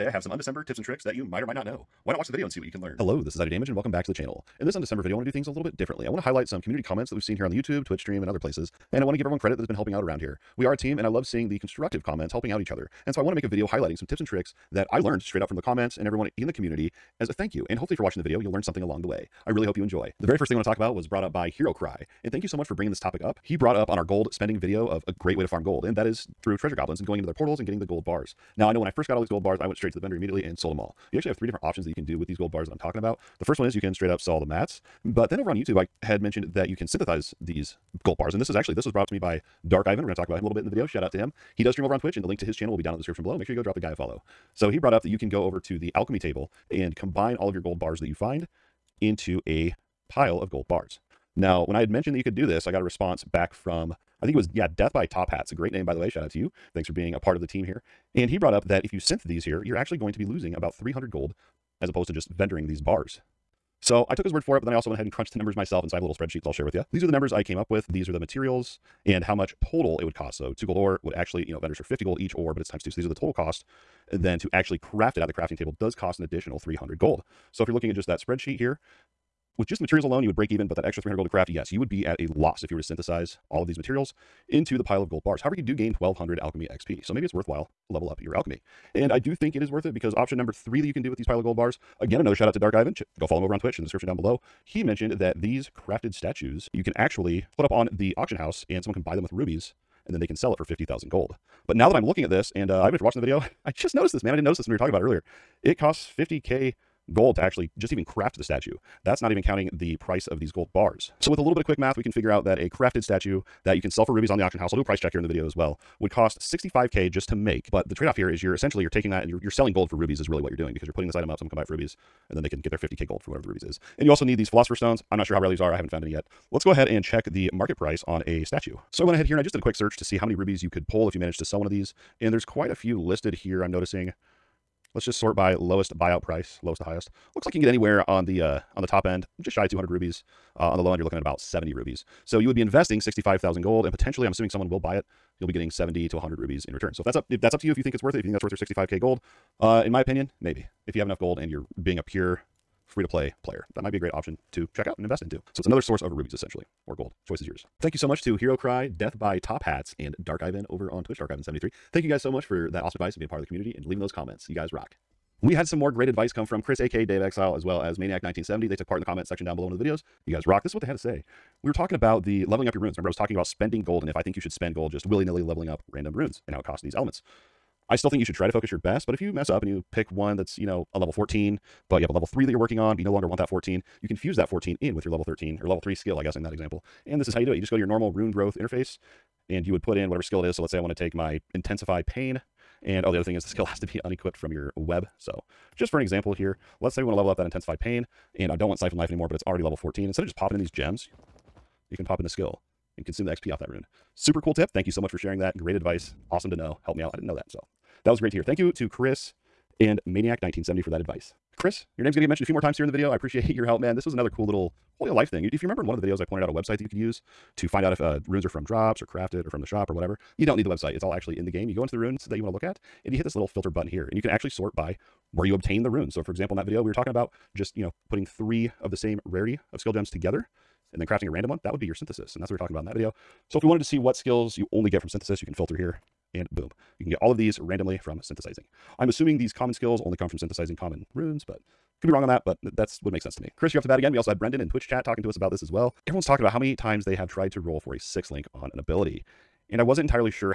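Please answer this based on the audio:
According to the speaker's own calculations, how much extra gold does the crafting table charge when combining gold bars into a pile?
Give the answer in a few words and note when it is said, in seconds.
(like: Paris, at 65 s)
300 gold, at 76 s.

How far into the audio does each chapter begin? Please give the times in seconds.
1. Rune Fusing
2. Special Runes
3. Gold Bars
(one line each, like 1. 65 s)
1. 164 s
2. 211 s
3. 20 s.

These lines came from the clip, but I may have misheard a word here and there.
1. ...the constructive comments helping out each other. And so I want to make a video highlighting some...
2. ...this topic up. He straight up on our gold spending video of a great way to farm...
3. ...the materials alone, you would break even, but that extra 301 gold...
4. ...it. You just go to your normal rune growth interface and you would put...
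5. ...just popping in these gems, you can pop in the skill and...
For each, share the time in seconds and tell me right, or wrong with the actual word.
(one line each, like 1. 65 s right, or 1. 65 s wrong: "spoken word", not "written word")
1. 11 s right
2. 22 s wrong: "brought", not "straight"
3. 79 s wrong: "300", not "301"
4. 187 s right
5. 200 s right.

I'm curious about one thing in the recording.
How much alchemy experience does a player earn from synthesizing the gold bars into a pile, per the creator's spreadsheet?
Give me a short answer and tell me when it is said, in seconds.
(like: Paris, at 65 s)
1200, at 85 s.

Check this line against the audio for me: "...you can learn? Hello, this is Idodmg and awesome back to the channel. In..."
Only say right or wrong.
wrong.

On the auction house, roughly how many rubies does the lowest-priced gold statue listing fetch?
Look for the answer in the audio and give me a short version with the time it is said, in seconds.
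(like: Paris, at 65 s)
70 rubies, at 141 s.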